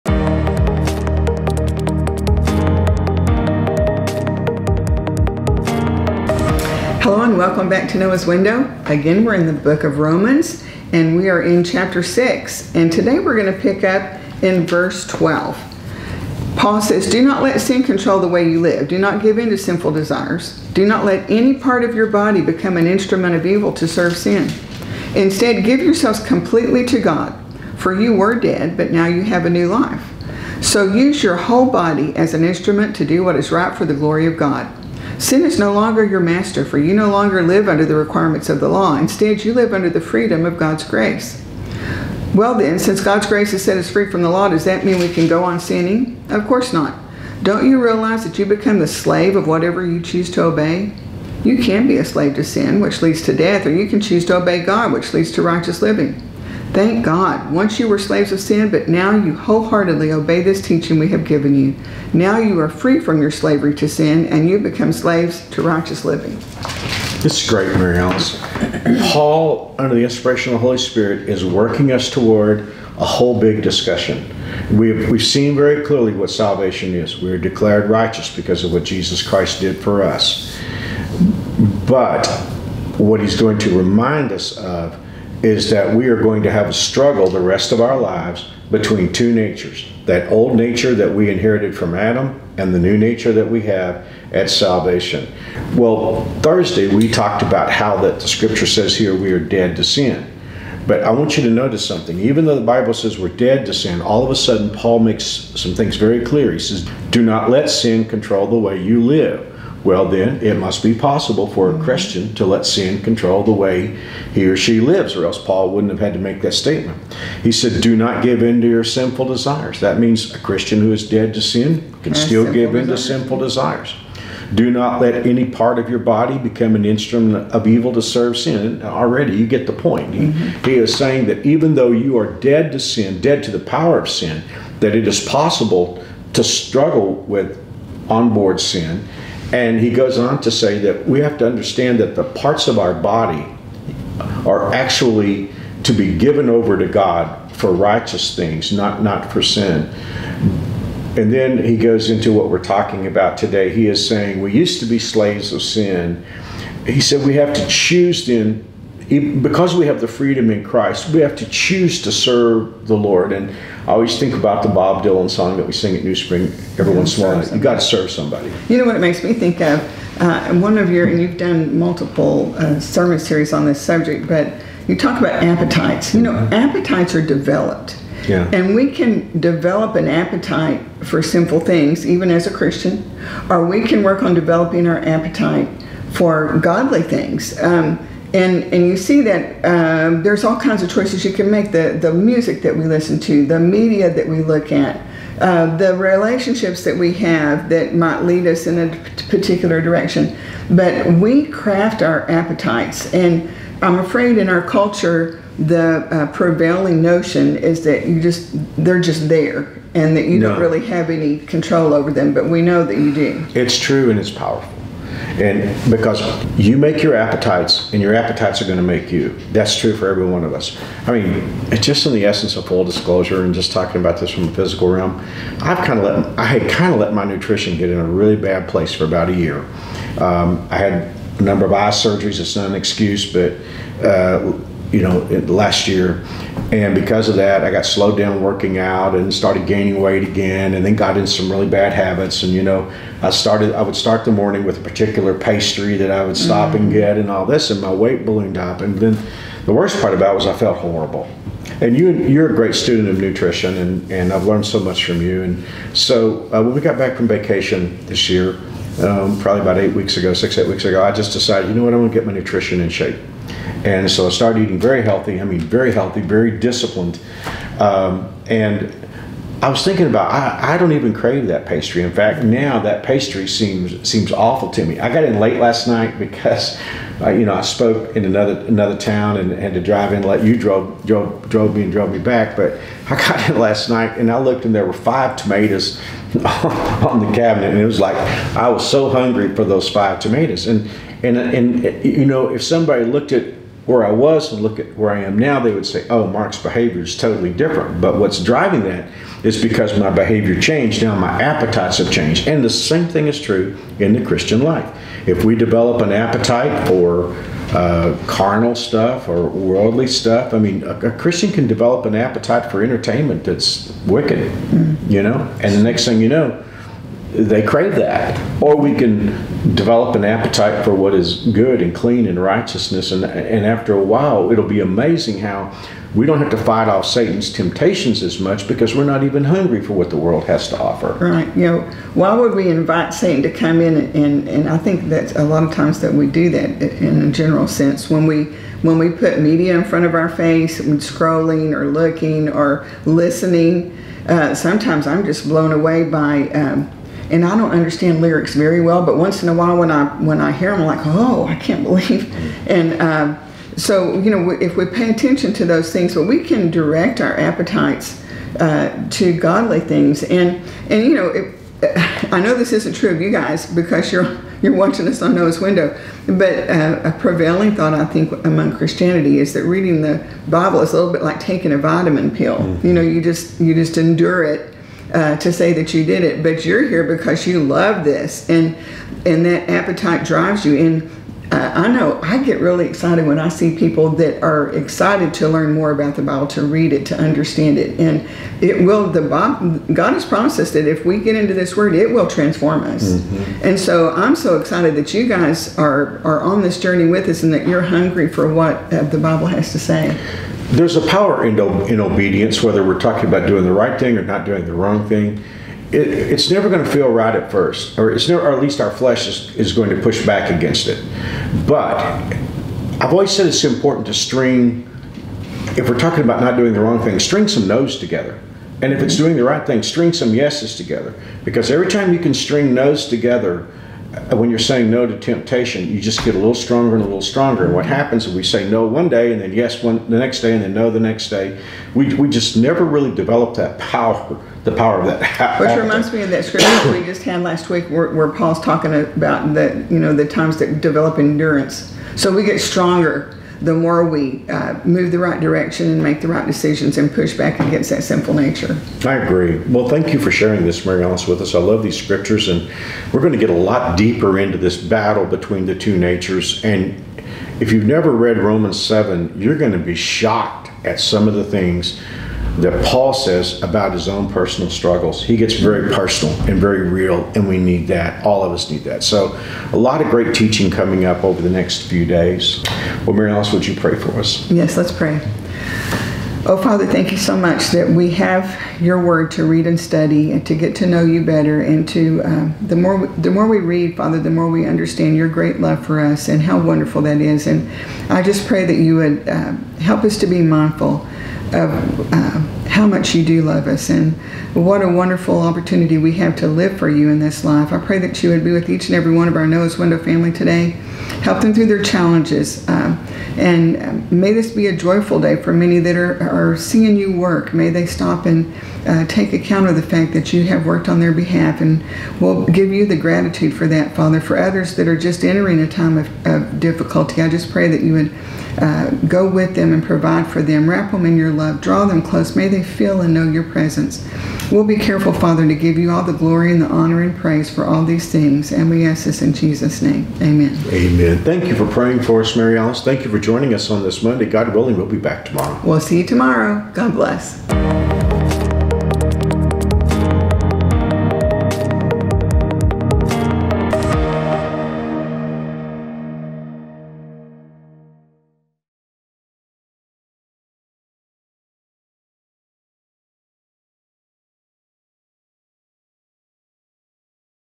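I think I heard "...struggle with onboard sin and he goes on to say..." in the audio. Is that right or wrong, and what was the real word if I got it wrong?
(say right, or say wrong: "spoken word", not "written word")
right.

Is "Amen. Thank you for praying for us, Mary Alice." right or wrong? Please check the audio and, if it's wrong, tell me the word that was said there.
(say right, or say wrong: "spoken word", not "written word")
right.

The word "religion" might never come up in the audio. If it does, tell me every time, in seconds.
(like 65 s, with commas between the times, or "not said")
not said.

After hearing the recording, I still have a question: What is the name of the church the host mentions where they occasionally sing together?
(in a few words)
New Spring.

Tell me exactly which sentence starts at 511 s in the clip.
And we'll give you the gratitude for that, Father.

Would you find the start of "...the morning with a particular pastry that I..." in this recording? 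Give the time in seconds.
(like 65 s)
244 s.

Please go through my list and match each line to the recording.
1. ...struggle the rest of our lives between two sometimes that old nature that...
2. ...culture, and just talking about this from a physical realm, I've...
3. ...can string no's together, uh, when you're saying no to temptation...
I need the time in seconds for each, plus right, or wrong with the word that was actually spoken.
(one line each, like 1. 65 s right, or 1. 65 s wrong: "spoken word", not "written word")
1. 86 s wrong: "natures", not "sometimes"
2. 222 s wrong: "disclosure", not "culture"
3. 422 s right.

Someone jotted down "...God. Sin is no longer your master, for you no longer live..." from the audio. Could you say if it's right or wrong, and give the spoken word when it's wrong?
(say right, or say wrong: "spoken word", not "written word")
right.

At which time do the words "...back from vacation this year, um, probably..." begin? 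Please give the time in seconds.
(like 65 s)
256 s.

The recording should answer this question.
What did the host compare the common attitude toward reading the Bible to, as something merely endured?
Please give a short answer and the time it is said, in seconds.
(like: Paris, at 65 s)
a vitamin pill, at 371 s.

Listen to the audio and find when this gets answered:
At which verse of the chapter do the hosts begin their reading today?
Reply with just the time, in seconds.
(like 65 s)
14 s.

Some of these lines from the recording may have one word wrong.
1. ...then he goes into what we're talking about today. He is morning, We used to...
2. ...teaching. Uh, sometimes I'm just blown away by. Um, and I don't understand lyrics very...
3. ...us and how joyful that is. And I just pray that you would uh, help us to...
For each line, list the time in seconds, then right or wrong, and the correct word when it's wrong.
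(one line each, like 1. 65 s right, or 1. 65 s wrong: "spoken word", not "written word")
1. 151 s wrong: "saying", not "morning"
2. 343 s wrong: "listening", not "teaching"
3. 486 s wrong: "wonderful", not "joyful".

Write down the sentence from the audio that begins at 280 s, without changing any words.
Let you drove drove drove me and drove me back.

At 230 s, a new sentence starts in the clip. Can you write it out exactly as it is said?
Um, I had a number of eye surgeries.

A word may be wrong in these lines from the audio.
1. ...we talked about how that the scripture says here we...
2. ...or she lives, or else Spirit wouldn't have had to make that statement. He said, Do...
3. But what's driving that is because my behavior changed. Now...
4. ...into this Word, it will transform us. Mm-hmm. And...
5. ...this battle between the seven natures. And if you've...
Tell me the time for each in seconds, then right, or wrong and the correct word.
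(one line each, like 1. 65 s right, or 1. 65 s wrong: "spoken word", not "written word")
1. 96 s right
2. 114 s wrong: "Paul", not "Spirit"
3. 298 s right
4. 391 s right
5. 454 s wrong: "two", not "seven".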